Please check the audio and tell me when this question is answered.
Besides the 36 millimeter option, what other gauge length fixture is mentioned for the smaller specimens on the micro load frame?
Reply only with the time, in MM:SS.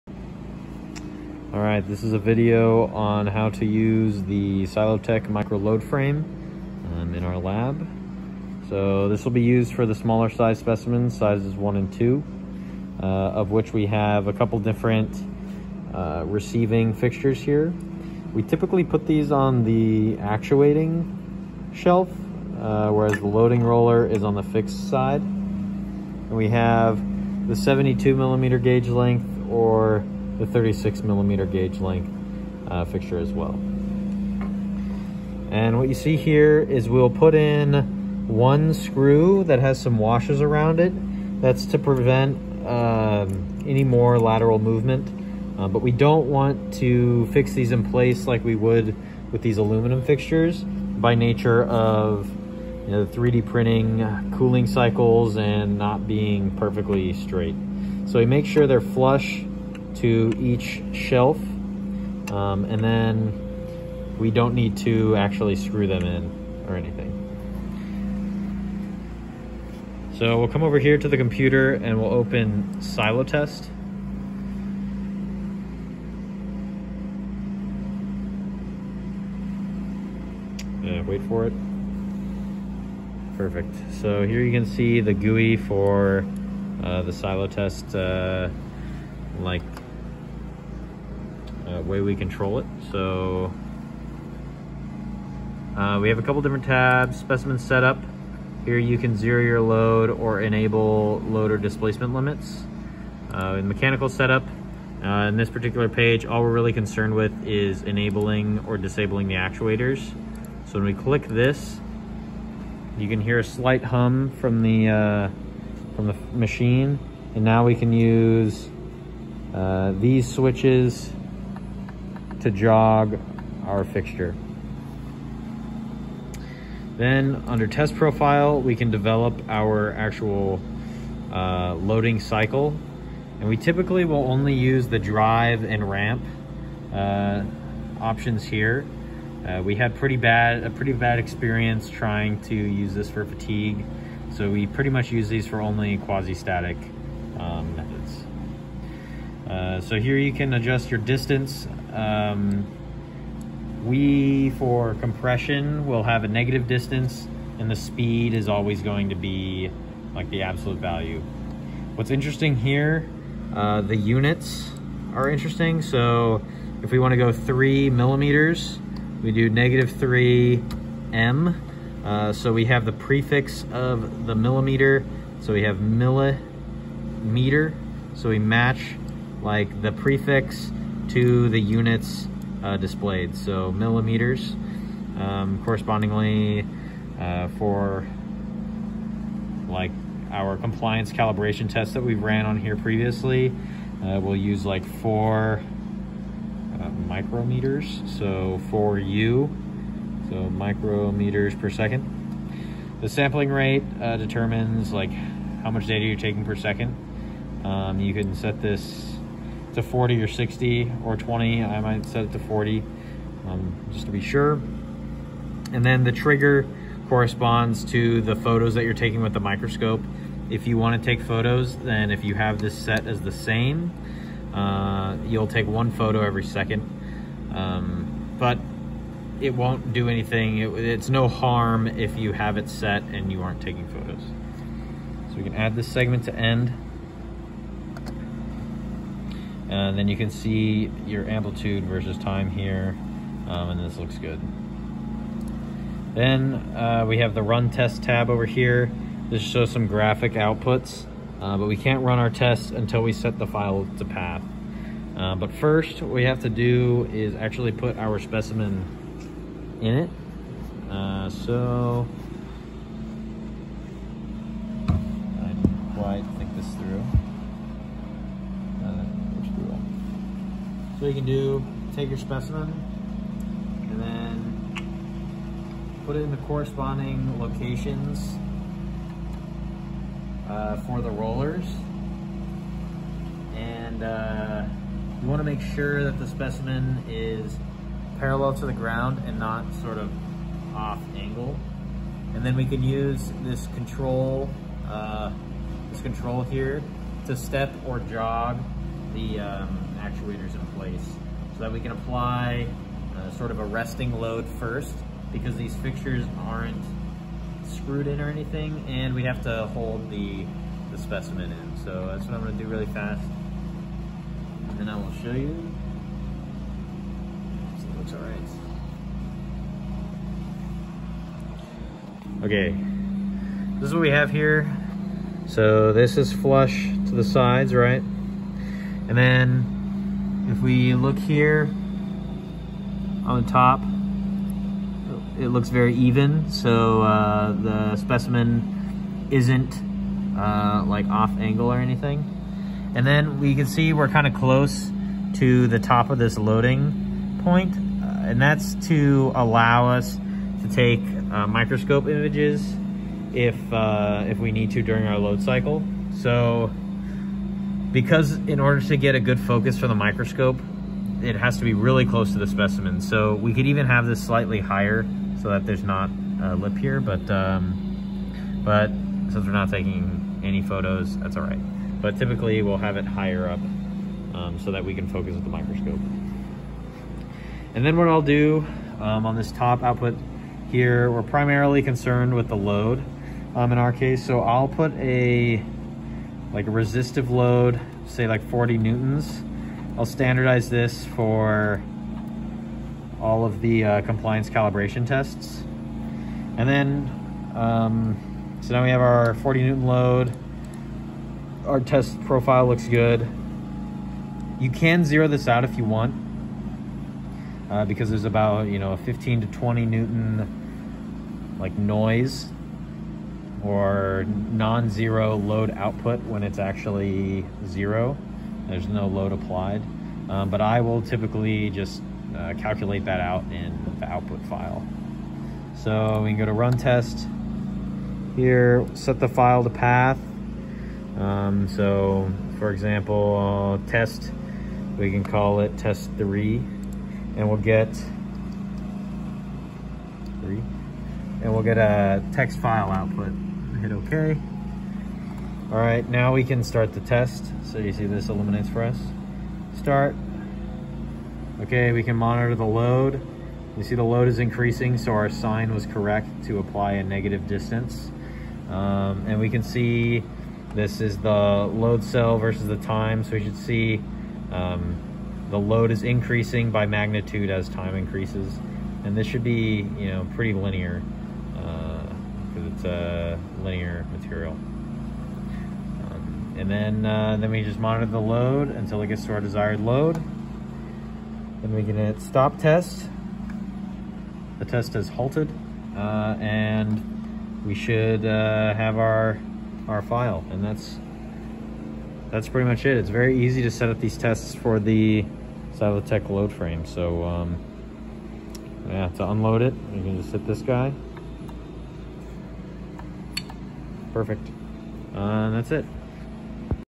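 00:27.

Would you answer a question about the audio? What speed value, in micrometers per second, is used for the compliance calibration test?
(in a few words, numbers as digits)
4.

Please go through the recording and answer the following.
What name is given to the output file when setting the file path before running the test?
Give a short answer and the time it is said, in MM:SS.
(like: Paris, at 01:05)
test three, at 07:15.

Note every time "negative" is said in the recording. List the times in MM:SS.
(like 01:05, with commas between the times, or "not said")
02:36, 02:49, 07:37.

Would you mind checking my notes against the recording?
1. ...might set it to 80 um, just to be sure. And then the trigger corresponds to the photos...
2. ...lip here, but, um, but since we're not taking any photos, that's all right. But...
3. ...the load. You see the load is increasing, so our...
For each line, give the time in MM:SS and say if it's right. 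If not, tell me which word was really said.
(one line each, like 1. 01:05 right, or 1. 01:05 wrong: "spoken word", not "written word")
1. 03:31 wrong: "40", not "80"
2. 06:06 right
3. 07:32 right.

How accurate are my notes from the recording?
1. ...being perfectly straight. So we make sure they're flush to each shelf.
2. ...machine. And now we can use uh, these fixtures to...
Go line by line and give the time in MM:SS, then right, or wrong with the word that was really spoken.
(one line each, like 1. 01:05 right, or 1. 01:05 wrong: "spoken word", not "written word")
1. 00:56 right
2. 01:56 wrong: "switches", not "fixtures".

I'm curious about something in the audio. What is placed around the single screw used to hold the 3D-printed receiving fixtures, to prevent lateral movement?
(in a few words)
washers.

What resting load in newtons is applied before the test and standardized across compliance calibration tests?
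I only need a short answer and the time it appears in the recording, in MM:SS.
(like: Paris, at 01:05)
40 newtons, at 06:28.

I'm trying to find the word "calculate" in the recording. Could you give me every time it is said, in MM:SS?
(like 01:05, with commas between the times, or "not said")
07:02.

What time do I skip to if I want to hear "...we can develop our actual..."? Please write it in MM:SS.
02:08.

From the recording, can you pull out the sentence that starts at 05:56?
So because in order to get a good focus for the microscope, it has to be really close to the specimen.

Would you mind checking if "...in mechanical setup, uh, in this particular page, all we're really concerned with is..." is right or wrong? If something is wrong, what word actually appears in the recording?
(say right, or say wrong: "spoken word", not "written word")
right.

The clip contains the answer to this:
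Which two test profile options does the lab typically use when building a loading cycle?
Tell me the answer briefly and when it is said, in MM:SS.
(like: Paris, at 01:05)
drive and ramp, at 02:14.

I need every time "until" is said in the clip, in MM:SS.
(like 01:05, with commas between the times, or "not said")
04:12, 07:58.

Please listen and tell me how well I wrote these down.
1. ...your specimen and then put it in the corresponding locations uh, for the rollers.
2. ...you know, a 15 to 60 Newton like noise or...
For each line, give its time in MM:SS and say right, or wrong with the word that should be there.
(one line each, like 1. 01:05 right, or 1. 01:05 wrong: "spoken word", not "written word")
1. 04:32 right
2. 06:48 wrong: "20", not "60".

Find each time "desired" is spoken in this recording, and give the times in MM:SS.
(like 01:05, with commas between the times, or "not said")
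07:59.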